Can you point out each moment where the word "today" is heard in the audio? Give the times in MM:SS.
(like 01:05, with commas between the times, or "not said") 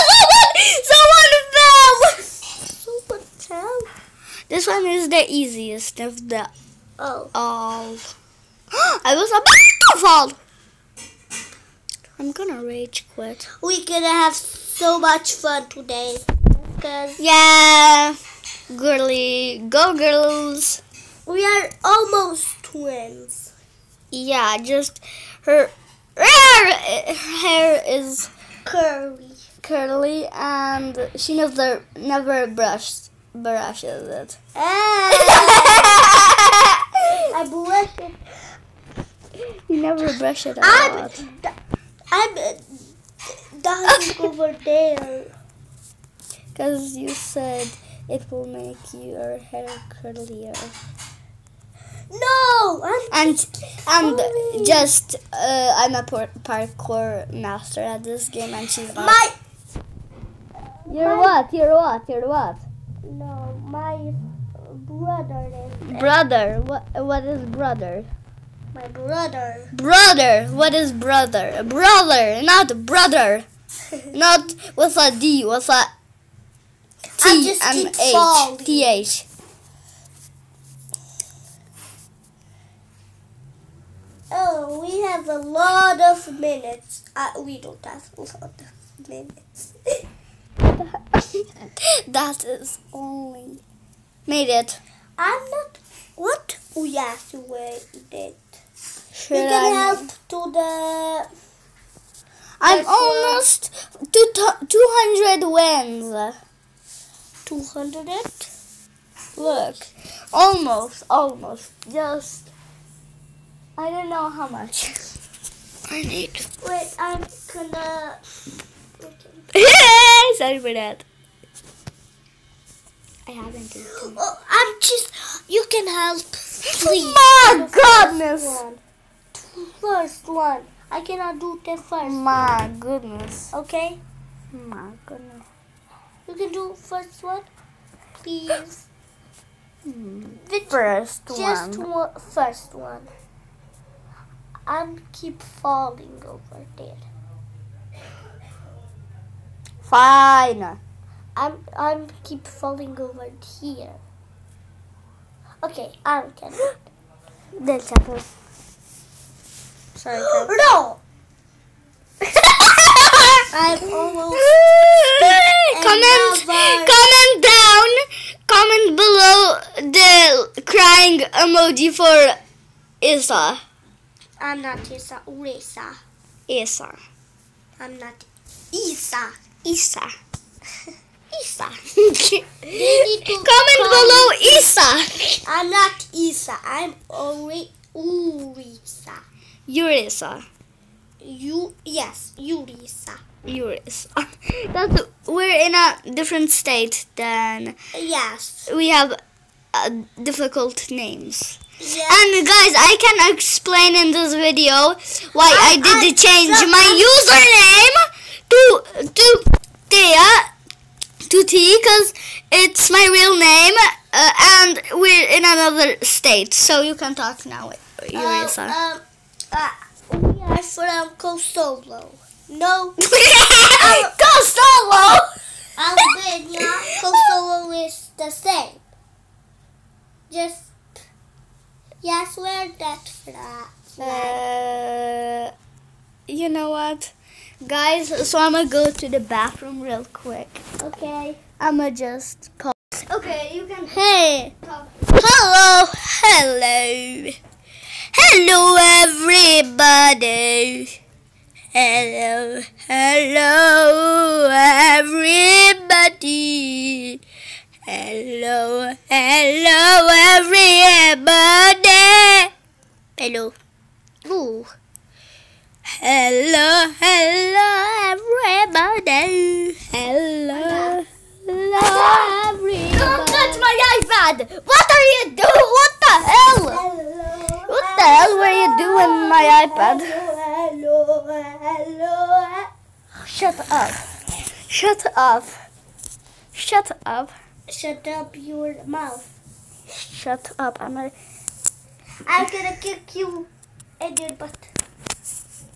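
00:15.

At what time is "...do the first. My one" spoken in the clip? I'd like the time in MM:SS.
02:11.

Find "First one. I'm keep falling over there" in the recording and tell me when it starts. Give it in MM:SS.
02:22.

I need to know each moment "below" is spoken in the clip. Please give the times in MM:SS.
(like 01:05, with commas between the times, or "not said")
02:48, 03:03.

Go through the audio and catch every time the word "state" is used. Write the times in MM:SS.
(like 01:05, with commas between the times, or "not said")
03:16, 03:36.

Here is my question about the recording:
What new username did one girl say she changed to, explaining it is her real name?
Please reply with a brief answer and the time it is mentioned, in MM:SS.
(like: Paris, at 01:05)
Thea Tuti, at 03:29.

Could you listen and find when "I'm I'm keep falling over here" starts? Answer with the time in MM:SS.
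02:31.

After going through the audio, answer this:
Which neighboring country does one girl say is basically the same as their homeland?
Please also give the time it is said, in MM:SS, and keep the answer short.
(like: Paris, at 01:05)
Albania, at 03:45.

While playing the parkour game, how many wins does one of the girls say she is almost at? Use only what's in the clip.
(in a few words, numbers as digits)
200.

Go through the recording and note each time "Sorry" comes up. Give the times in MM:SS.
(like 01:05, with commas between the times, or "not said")
02:00, 02:39.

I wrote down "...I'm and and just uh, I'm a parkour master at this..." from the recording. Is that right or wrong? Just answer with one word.
right.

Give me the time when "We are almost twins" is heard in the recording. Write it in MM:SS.
00:21.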